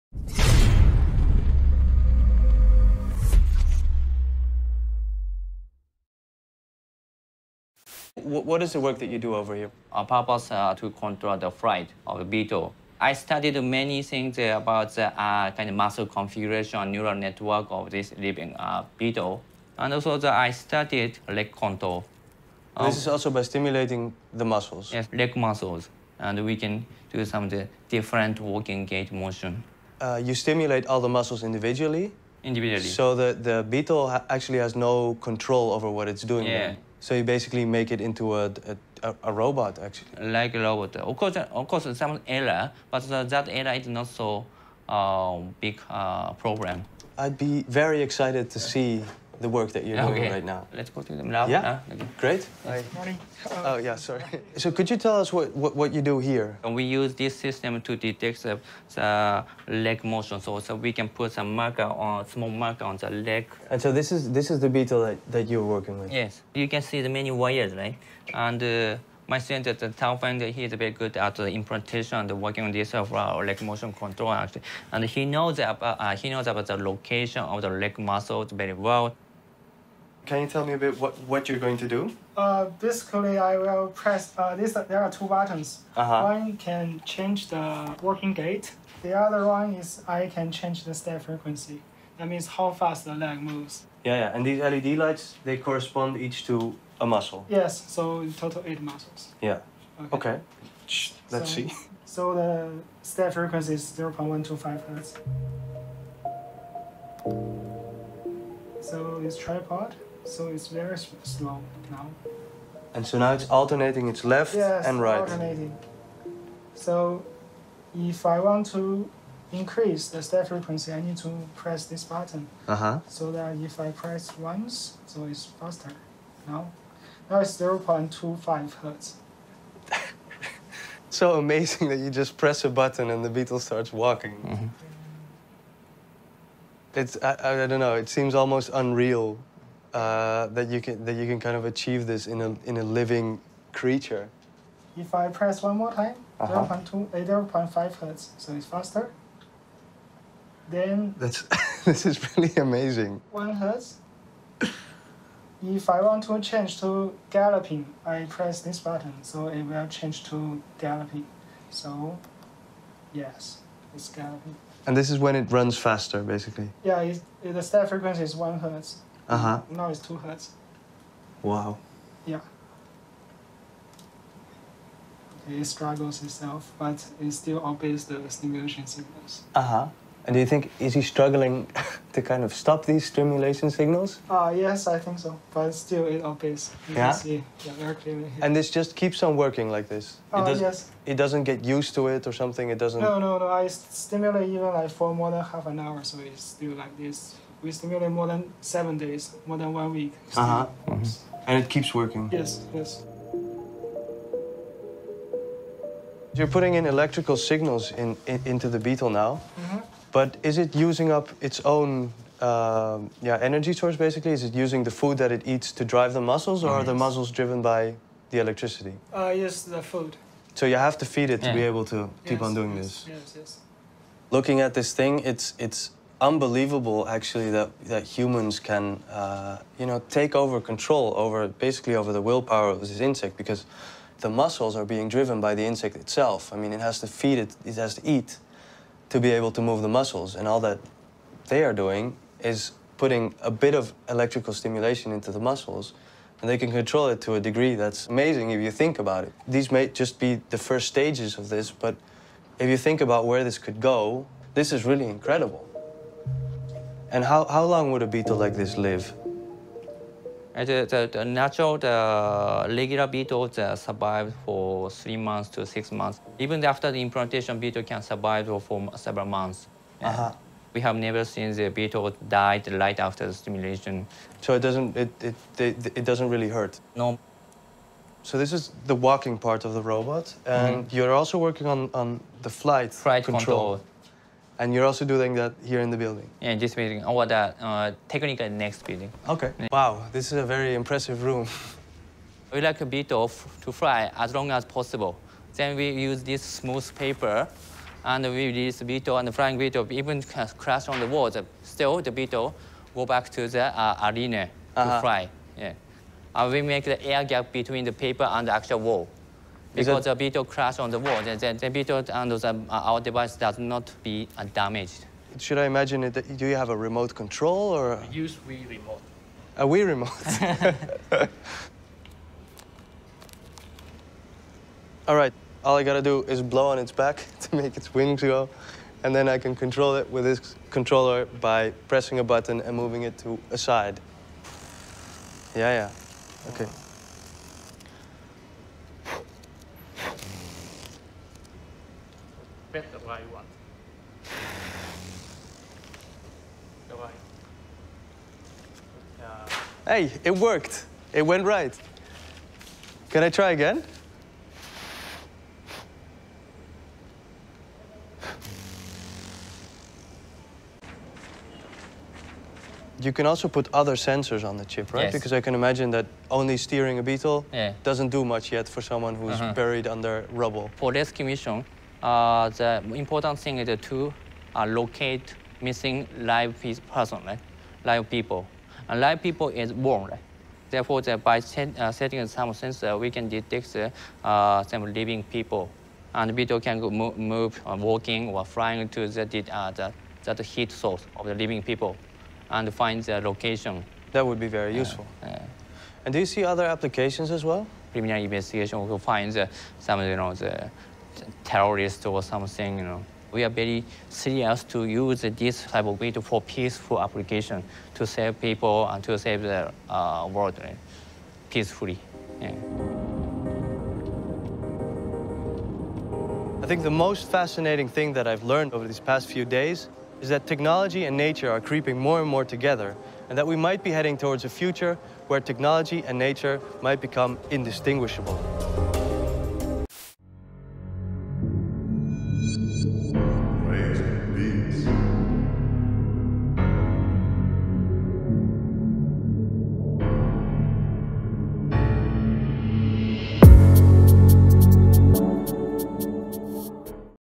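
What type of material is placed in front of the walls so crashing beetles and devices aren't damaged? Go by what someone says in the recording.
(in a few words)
Smooth paper.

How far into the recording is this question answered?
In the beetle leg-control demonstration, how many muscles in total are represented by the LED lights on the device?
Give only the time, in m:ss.
1:38.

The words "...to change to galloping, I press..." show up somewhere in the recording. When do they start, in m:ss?
2:36.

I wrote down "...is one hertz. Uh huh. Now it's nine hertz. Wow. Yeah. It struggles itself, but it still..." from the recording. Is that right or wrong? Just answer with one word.
wrong.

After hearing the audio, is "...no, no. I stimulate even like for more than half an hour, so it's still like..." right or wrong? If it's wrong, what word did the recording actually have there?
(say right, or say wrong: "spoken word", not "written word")
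right.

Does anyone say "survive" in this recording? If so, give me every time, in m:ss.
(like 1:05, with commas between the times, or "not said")
4:23, 4:28.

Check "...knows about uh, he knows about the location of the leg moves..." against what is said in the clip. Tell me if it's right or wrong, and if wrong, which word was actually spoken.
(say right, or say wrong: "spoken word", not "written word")
wrong: "muscles", not "moves".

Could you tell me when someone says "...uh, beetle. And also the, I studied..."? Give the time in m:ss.
0:18.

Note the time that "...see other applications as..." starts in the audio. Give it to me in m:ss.
6:36.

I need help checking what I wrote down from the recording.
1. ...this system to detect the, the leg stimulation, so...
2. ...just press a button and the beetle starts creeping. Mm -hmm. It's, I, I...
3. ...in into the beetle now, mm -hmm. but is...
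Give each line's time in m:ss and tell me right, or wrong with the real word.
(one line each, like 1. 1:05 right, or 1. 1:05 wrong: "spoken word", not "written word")
1. 0:57 wrong: "motion", not "stimulation"
2. 2:12 wrong: "walking", not "creeping"
3. 3:28 right.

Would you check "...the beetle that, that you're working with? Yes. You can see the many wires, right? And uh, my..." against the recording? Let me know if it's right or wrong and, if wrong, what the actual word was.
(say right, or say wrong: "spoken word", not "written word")
right.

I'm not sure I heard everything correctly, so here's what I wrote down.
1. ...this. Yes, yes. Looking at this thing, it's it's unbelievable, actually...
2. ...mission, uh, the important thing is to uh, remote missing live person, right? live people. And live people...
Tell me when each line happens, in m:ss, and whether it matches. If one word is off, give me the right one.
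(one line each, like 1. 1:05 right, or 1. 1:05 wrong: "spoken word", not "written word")
1. 3:42 right
2. 6:11 wrong: "locate", not "remote".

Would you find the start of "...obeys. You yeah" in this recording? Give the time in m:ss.
3:06.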